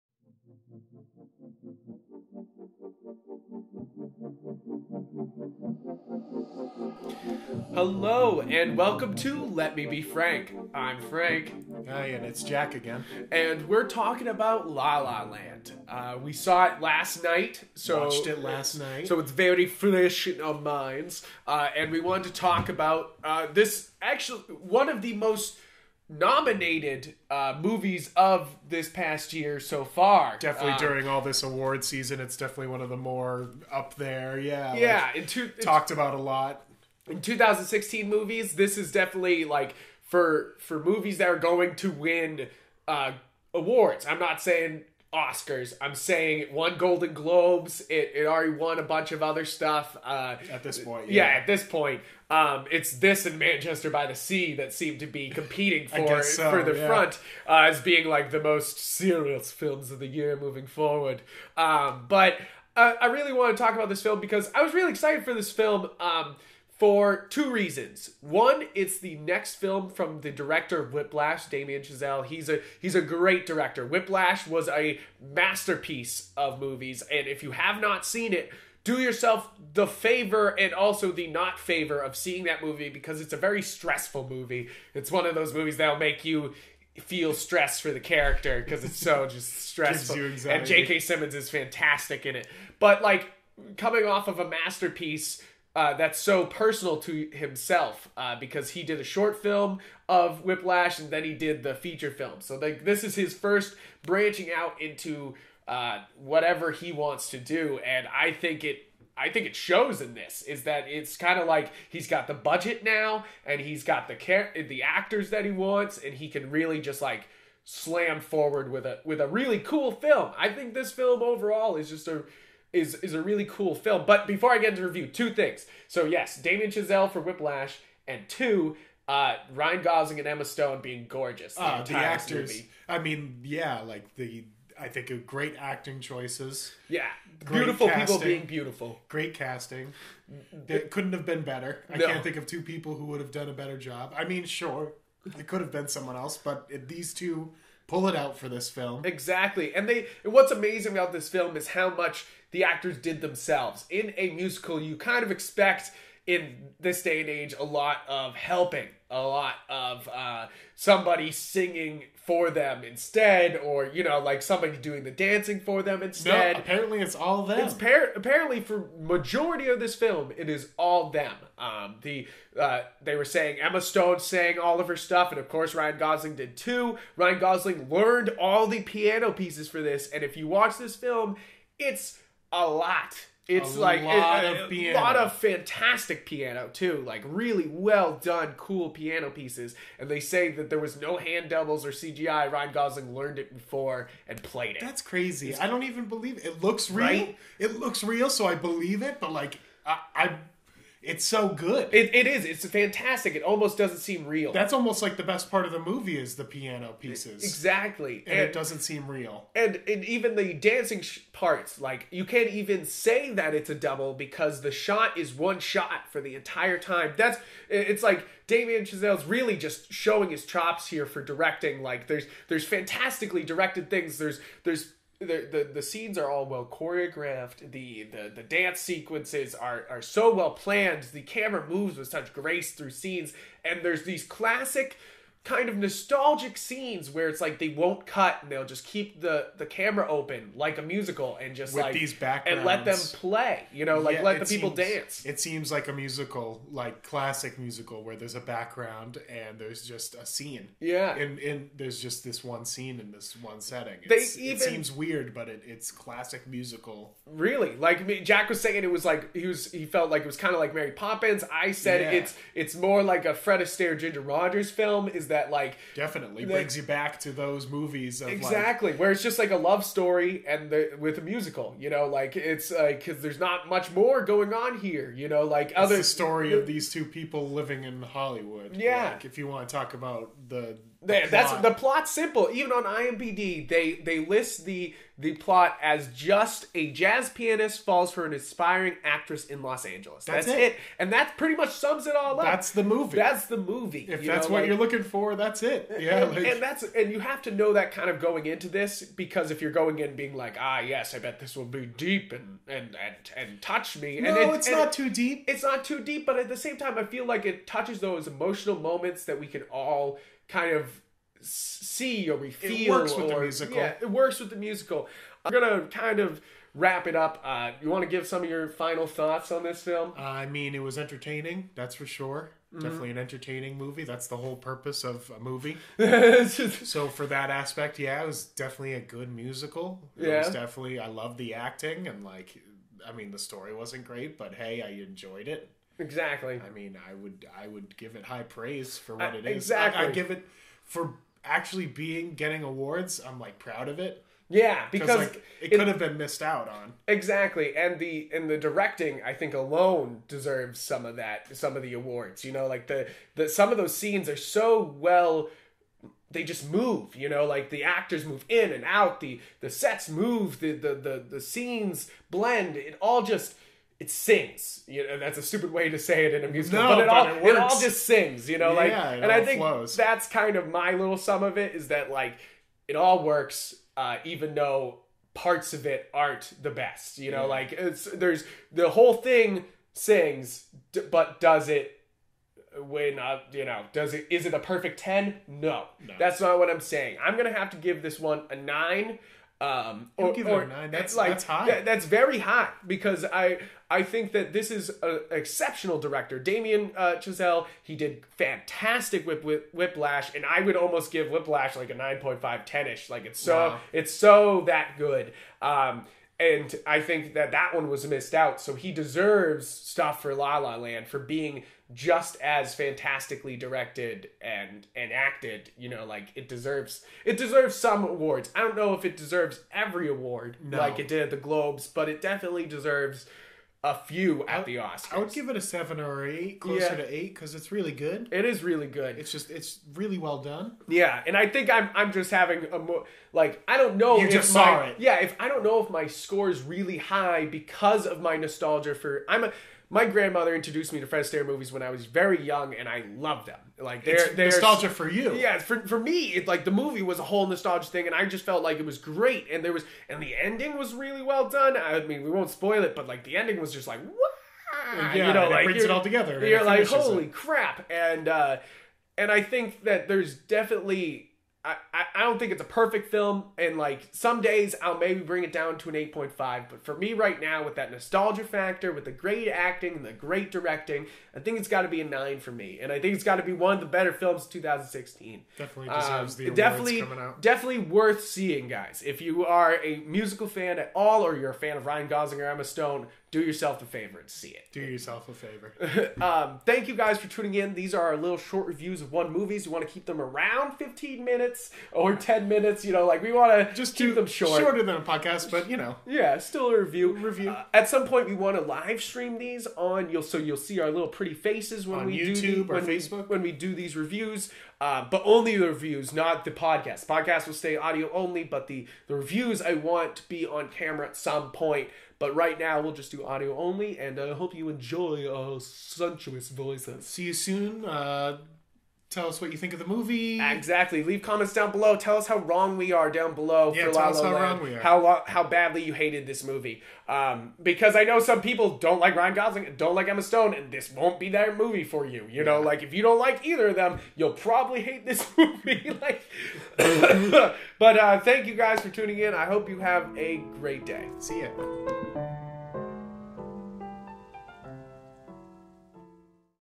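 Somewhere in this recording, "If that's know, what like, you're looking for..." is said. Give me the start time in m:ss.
4:54.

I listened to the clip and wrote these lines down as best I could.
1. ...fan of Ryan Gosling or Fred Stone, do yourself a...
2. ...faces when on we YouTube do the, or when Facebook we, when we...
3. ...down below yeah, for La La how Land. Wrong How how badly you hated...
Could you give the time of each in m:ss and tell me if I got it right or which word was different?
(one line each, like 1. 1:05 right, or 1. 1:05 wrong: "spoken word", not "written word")
1. 8:01 wrong: "Emma", not "Fred"
2. 8:21 right
3. 8:43 right.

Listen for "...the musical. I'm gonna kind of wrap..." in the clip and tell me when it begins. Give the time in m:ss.
5:14.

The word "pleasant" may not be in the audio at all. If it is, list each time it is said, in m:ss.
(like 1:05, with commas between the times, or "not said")
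not said.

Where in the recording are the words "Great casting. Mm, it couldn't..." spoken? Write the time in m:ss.
2:19.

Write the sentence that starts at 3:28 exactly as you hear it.
And, and it doesn't seem real.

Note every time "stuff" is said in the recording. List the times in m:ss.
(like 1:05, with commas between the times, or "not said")
0:49, 2:54, 6:49.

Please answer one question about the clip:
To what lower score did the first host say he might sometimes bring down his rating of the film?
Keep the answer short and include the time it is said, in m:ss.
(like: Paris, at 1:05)
8.5, at 7:45.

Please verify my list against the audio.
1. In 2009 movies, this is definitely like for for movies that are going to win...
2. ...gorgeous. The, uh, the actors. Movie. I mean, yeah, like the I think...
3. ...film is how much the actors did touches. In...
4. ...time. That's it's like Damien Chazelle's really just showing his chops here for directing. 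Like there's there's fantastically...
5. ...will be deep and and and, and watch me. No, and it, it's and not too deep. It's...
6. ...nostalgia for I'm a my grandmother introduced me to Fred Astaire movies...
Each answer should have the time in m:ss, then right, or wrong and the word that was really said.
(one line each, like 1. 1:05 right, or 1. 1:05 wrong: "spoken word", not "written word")
1. 0:37 wrong: "2016", not "2009"
2. 2:11 right
3. 2:31 wrong: "themselves", not "touches"
4. 3:36 right
5. 5:01 wrong: "touch", not "watch"
6. 7:18 right.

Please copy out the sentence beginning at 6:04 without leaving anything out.
You know, that's a stupid way to say it in a musical, no, but it but all it, it, all just sings.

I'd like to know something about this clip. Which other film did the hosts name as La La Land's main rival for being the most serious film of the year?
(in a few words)
Manchester by the Sea.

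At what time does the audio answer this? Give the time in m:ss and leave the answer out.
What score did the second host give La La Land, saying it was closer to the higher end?
7:05.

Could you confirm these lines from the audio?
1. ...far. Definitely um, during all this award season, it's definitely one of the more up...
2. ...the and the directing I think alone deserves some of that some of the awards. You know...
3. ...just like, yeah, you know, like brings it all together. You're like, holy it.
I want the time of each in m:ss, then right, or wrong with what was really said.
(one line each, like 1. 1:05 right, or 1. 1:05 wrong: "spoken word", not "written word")
1. 0:29 right
2. 5:47 right
3. 7:33 right.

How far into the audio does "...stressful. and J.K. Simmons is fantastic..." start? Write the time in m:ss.
1:29.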